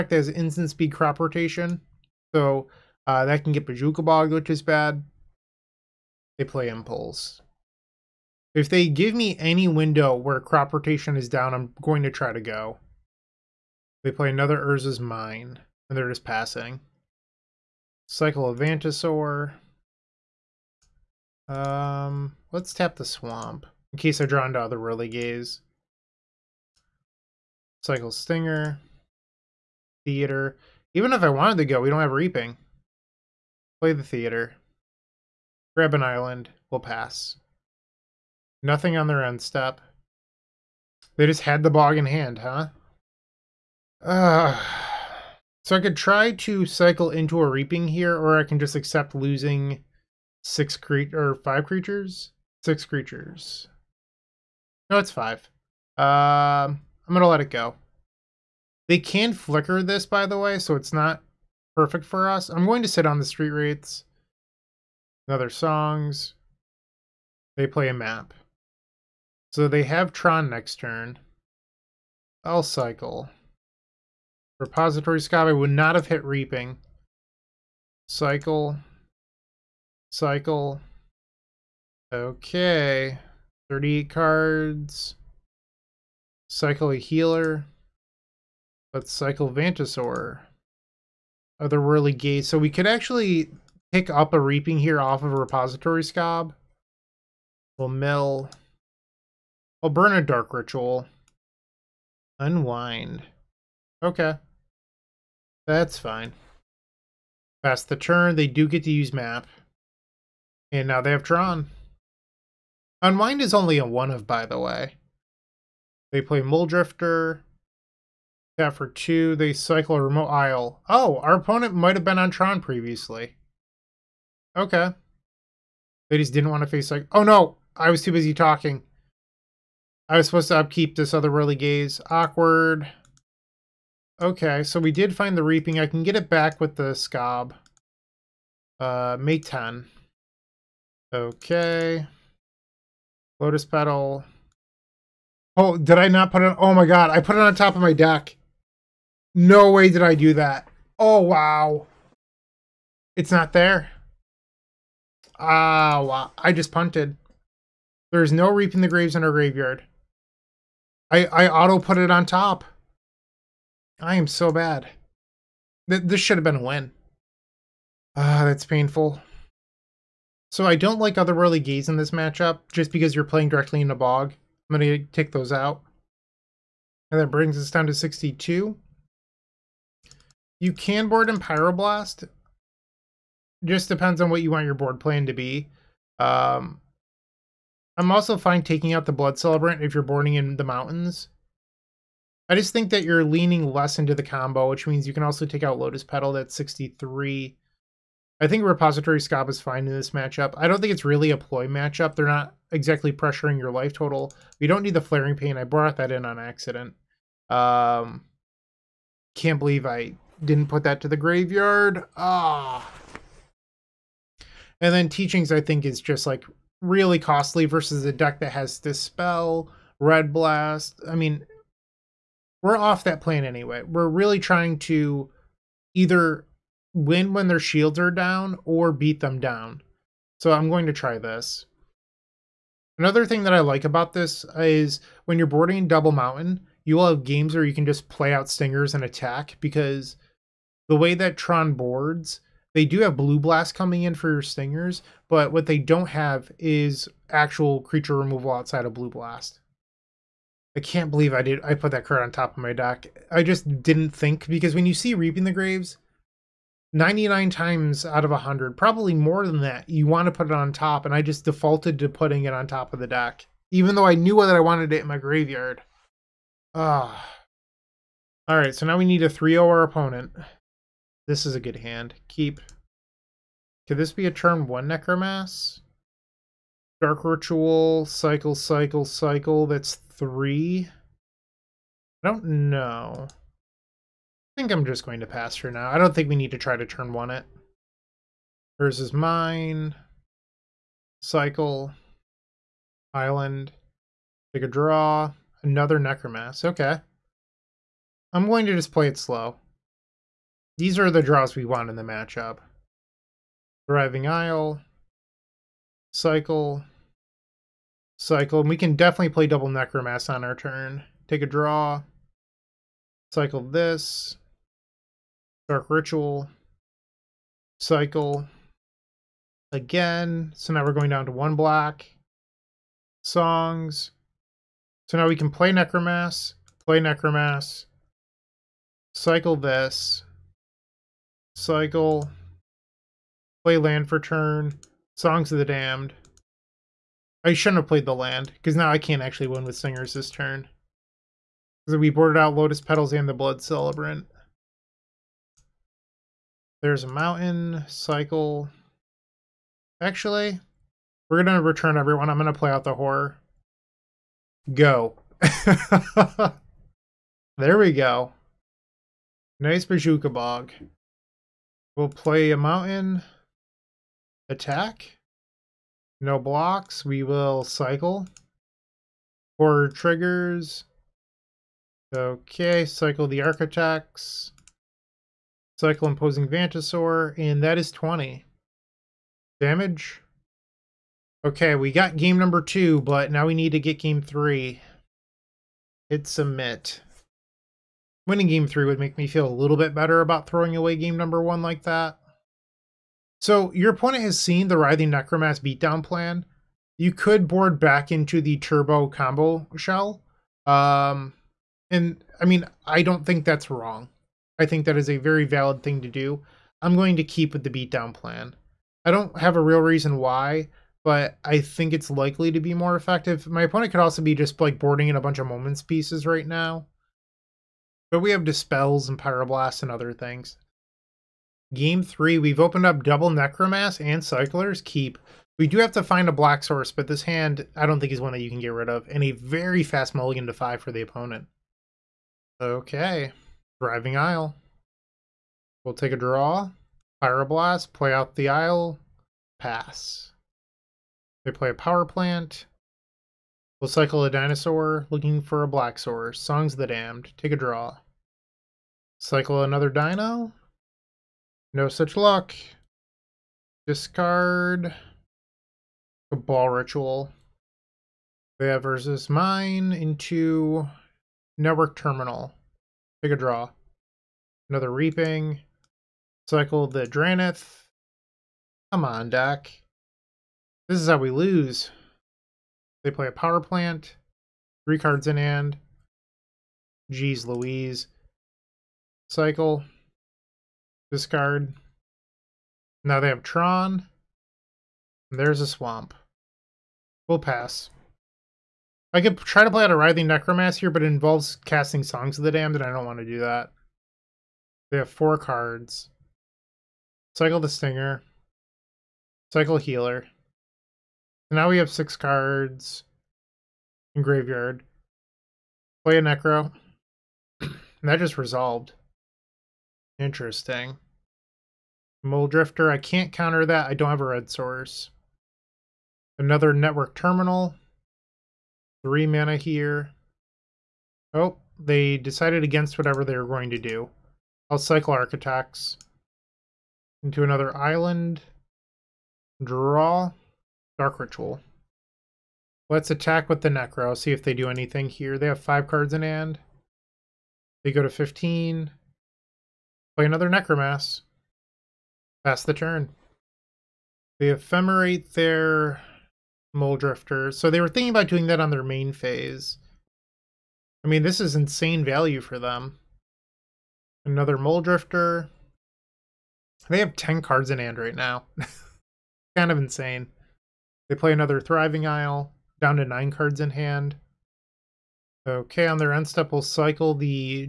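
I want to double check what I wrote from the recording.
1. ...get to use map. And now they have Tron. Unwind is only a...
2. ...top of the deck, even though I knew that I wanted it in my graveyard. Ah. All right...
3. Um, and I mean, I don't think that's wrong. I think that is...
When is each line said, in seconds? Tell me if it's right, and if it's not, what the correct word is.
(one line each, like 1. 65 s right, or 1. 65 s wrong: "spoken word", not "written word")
1. 108 s right
2. 262 s right
3. 400 s right.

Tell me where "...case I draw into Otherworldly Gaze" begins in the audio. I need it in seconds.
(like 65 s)
23 s.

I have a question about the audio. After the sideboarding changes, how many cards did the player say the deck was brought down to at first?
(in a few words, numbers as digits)
62.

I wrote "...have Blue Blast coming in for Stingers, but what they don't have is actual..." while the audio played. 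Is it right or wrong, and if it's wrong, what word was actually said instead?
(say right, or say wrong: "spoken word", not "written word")
right.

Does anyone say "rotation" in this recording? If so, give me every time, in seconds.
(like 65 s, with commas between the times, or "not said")
1 s, 10 s.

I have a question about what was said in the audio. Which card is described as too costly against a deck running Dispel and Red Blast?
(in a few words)
Teachings.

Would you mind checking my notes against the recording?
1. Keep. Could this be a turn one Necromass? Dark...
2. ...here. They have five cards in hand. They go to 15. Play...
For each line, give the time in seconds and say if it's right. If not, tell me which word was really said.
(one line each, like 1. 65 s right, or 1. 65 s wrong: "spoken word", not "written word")
1. 272 s right
2. 535 s right.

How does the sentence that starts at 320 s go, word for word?
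So now we're going down to one block, songs.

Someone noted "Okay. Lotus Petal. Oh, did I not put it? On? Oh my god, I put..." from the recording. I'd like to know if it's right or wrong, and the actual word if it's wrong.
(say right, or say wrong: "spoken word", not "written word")
right.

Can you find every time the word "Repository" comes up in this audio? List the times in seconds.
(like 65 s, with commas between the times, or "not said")
74 s, 95 s, 198 s.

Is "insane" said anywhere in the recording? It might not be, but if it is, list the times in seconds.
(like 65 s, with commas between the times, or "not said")
551 s, 559 s.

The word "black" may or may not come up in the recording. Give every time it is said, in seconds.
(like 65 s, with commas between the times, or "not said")
426 s, 445 s.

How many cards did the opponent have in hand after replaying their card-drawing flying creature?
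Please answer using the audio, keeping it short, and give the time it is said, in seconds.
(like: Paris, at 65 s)
10, at 556 s.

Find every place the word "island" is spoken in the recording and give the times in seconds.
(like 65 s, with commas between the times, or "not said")
36 s, 293 s, 527 s.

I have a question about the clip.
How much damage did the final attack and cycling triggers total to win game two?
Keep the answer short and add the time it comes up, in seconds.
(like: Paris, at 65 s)
20, at 377 s.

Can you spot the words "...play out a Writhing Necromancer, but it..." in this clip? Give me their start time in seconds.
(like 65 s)
489 s.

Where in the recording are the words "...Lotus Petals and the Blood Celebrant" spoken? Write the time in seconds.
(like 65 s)
342 s.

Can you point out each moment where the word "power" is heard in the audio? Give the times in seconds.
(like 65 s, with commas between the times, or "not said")
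441 s, 473 s.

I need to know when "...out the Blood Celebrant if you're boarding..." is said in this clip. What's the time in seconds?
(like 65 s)
188 s.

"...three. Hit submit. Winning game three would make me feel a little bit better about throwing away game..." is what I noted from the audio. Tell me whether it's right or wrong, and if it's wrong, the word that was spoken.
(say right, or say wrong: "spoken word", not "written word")
right.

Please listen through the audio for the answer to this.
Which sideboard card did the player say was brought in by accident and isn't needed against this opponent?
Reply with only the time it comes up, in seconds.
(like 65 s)
204 s.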